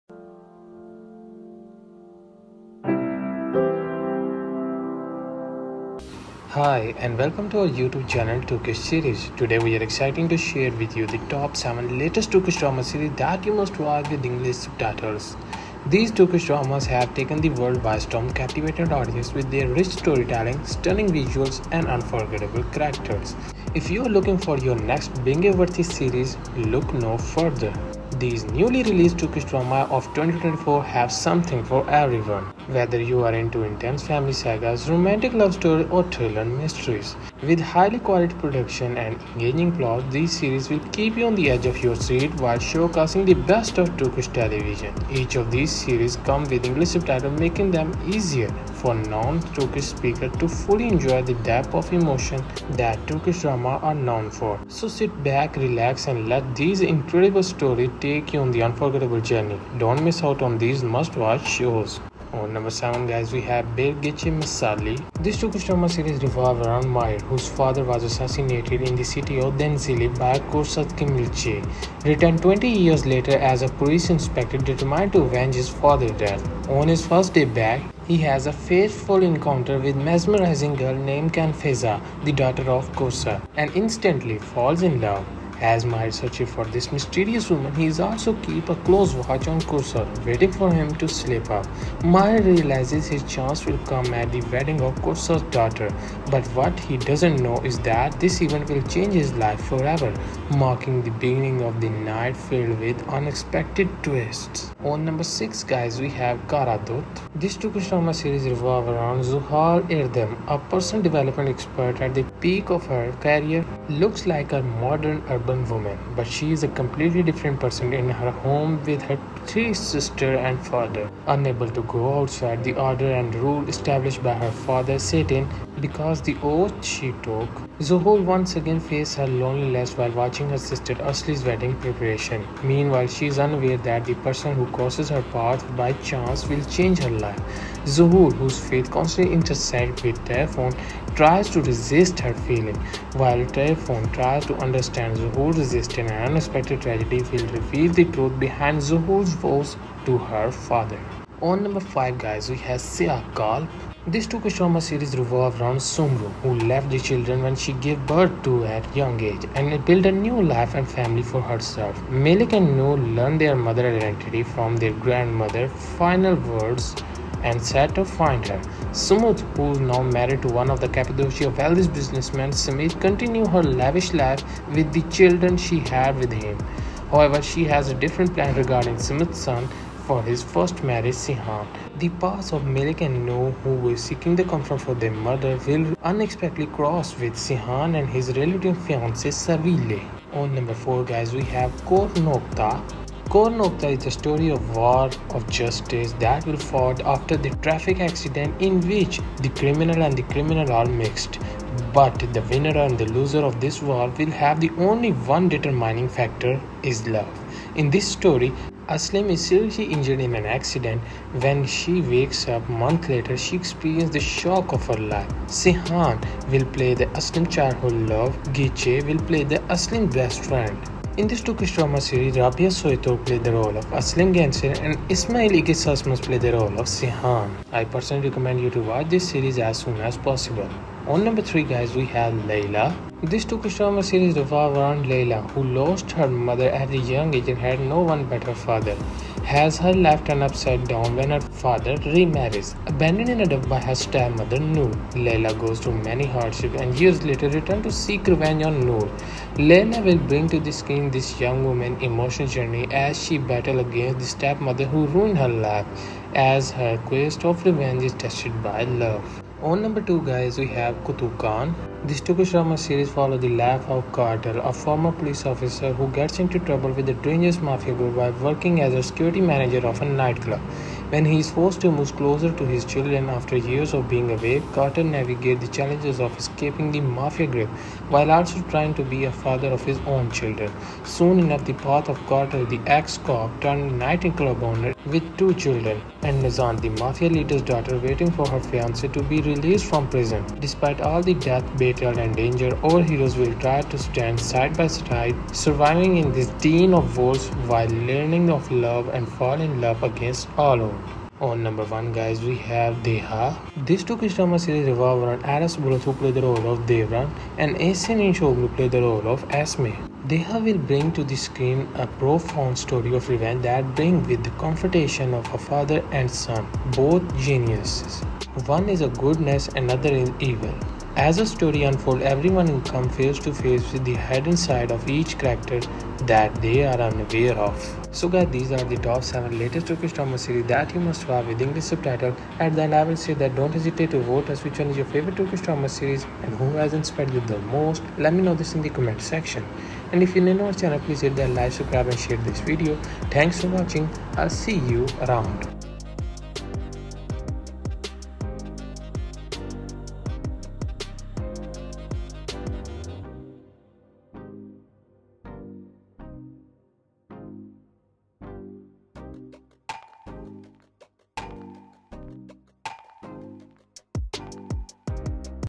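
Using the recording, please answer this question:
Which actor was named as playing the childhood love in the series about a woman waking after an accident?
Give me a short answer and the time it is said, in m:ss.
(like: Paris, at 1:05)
Ismail Igis, at 3:45.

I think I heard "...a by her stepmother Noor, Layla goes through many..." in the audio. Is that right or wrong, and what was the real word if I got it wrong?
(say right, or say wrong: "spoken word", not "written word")
right.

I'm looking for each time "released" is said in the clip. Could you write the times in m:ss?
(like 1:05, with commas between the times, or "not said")
0:28, 4:49.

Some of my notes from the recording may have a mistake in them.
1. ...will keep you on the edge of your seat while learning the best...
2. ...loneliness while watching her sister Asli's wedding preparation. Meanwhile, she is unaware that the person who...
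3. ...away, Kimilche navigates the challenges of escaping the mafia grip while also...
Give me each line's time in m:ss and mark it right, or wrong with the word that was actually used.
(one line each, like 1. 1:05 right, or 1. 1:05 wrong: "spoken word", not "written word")
1. 0:40 wrong: "showcasing", not "learning"
2. 2:09 right
3. 4:34 wrong: "Carter", not "Kimilche".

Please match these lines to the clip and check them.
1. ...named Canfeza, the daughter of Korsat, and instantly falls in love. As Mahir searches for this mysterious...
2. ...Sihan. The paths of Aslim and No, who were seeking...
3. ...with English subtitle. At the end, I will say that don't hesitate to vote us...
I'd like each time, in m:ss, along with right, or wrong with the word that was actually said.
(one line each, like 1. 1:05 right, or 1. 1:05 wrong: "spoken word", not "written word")
1. 1:21 right
2. 3:01 wrong: "Malik", not "Aslim"
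3. 5:31 right.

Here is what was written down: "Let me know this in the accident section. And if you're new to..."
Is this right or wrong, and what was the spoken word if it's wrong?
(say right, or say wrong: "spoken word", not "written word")
wrong: "comment", not "accident".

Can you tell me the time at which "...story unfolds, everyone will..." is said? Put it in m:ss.
5:21.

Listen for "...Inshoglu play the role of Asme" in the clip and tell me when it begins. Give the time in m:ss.
5:08.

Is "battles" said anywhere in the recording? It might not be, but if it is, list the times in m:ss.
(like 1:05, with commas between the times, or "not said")
4:13, 4:51.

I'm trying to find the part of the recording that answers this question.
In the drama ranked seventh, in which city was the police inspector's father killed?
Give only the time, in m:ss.
1:09.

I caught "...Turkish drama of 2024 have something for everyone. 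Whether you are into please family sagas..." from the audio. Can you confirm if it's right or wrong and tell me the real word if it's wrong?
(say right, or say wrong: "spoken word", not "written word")
wrong: "intense", not "please".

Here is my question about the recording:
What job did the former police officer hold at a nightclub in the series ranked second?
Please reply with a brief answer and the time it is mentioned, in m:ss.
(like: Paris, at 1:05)
security manager, at 4:29.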